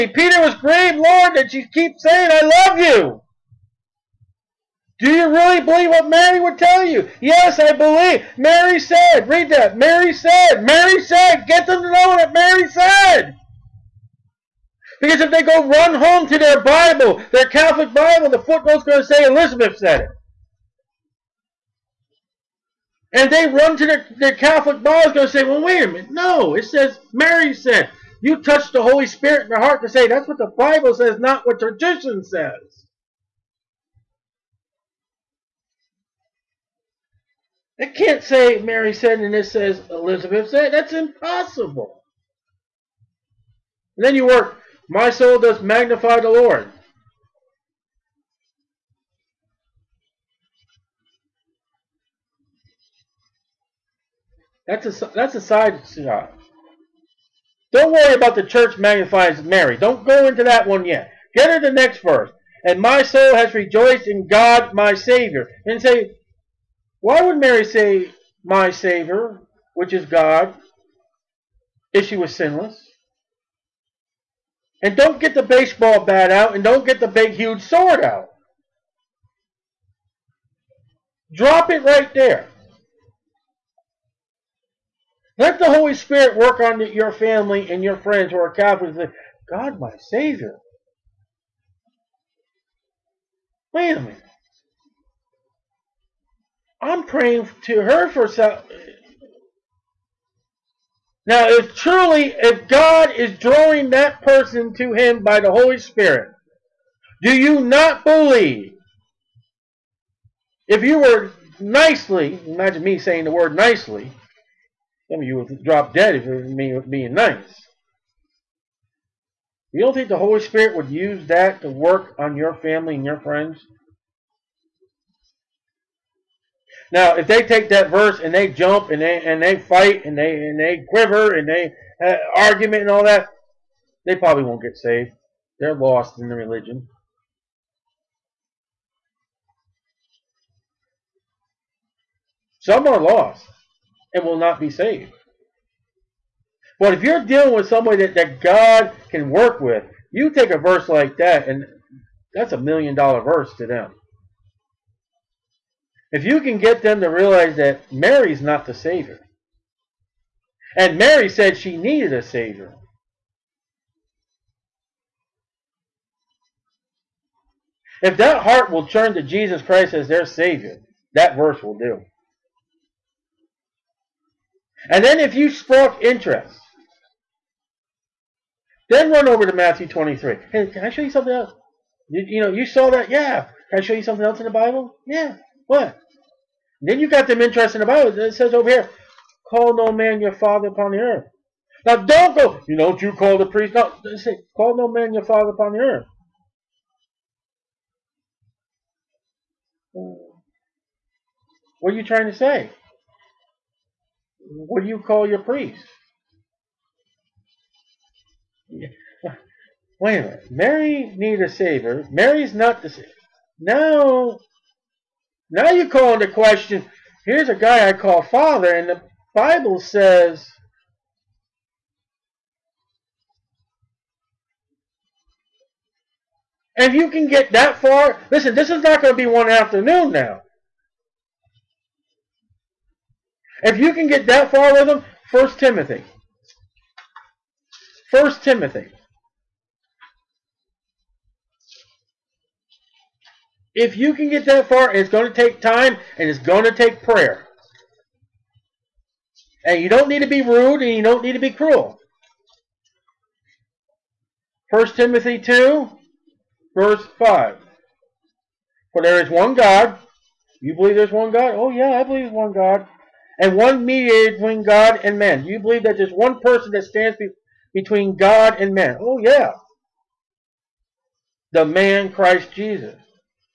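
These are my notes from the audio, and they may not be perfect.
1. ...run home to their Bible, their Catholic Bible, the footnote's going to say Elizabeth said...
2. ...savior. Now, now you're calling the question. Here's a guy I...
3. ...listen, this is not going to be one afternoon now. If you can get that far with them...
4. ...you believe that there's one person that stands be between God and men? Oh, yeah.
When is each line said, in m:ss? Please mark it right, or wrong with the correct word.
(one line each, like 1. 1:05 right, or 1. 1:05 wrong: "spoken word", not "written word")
1. 0:15 right
2. 3:32 right
3. 3:48 right
4. 4:25 right.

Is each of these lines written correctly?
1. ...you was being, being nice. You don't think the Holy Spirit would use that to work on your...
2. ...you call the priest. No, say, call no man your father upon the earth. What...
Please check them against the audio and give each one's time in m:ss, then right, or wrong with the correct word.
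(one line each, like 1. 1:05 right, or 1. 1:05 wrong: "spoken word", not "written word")
1. 1:56 right
2. 3:12 right.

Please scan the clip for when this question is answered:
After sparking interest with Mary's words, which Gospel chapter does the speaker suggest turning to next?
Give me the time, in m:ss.
2:59.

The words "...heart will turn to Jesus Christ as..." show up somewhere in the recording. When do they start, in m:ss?
2:48.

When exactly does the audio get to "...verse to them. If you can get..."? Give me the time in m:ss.
2:33.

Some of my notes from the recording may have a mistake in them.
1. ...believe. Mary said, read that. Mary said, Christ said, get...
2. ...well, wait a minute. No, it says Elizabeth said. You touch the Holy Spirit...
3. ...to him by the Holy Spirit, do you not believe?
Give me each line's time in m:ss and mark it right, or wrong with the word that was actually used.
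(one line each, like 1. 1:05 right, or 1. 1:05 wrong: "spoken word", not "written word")
1. 0:07 wrong: "Mary", not "Christ"
2. 0:25 wrong: "Mary", not "Elizabeth"
3. 1:44 right.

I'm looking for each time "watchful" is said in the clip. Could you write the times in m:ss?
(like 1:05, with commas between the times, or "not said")
not said.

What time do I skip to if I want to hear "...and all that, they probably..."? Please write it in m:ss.
2:12.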